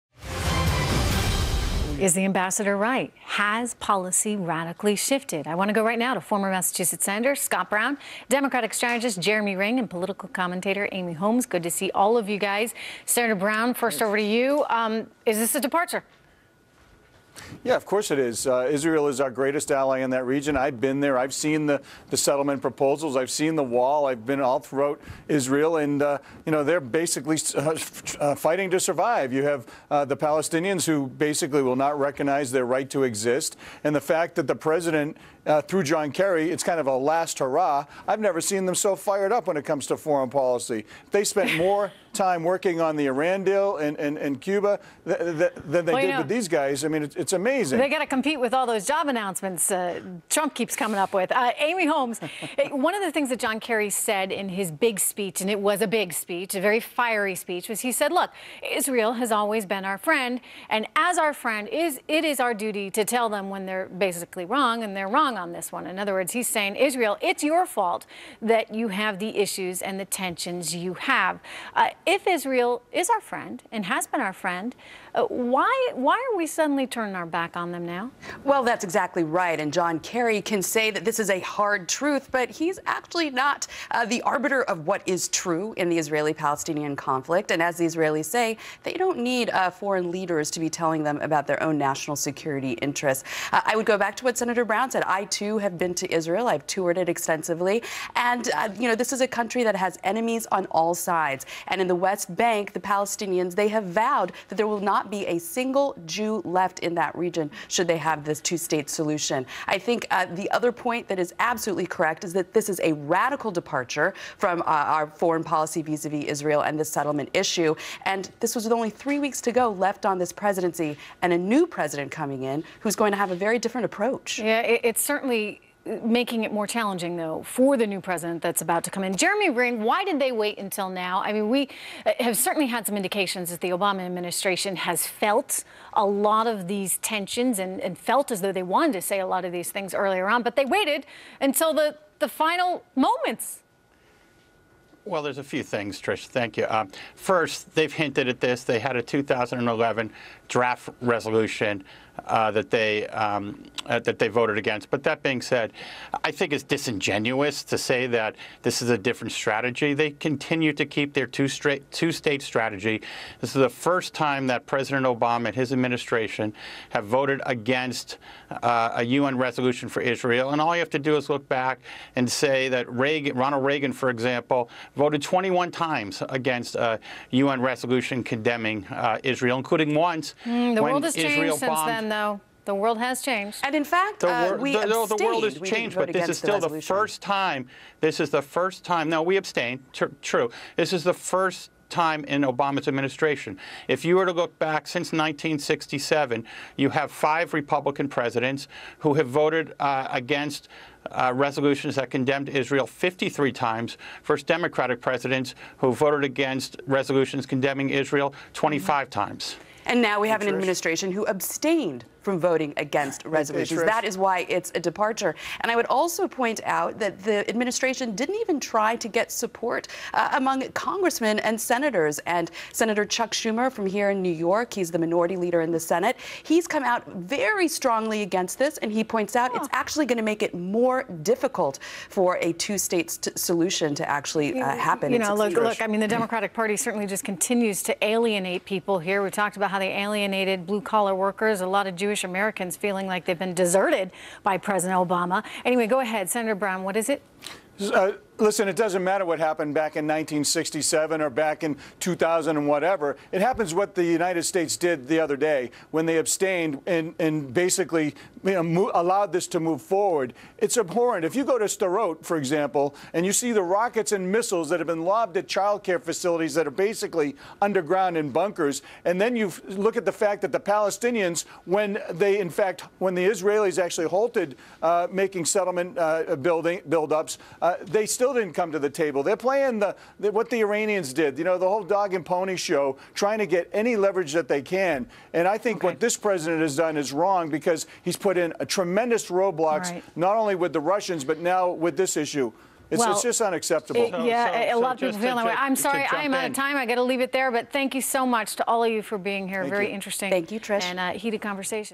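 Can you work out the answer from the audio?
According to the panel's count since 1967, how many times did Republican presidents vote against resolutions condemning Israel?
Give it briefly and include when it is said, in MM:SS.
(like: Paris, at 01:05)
53, at 03:22.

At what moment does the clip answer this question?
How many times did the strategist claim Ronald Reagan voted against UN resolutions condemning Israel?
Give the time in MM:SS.
02:55.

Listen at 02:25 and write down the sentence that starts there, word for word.
Well, there's a few things, Trish.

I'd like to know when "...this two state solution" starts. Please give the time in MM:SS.
01:48.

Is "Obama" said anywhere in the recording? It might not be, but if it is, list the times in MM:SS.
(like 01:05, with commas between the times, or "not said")
02:13, 02:45, 03:12, 04:04.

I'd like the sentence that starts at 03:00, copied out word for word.
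Mm, the world has Israel changed since then, though.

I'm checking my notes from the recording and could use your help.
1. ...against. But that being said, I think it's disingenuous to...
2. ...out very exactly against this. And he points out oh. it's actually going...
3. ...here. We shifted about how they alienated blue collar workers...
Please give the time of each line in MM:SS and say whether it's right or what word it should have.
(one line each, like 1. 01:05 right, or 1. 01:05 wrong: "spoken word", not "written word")
1. 02:34 right
2. 03:46 wrong: "strongly", not "exactly"
3. 03:58 wrong: "talked", not "shifted".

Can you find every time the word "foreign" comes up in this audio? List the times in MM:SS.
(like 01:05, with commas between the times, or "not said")
00:39, 01:29, 01:55.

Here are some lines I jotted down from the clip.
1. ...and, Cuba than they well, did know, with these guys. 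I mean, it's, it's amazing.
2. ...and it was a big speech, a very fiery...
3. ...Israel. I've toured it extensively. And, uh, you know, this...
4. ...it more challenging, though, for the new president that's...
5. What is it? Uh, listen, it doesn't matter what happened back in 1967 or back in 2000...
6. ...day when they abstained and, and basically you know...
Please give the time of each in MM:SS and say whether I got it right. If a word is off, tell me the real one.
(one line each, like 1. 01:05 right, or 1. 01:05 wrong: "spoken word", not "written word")
1. 00:43 right
2. 00:55 right
3. 01:36 right
4. 02:06 right
5. 04:06 right
6. 04:15 right.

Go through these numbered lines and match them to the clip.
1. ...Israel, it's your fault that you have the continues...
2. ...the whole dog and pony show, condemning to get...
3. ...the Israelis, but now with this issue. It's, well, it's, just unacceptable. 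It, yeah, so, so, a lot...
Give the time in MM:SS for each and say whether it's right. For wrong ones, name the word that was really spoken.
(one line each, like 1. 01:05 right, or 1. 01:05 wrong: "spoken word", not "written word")
1. 01:06 wrong: "issues", not "continues"
2. 04:41 wrong: "trying", not "condemning"
3. 04:50 wrong: "Russians", not "Israelis".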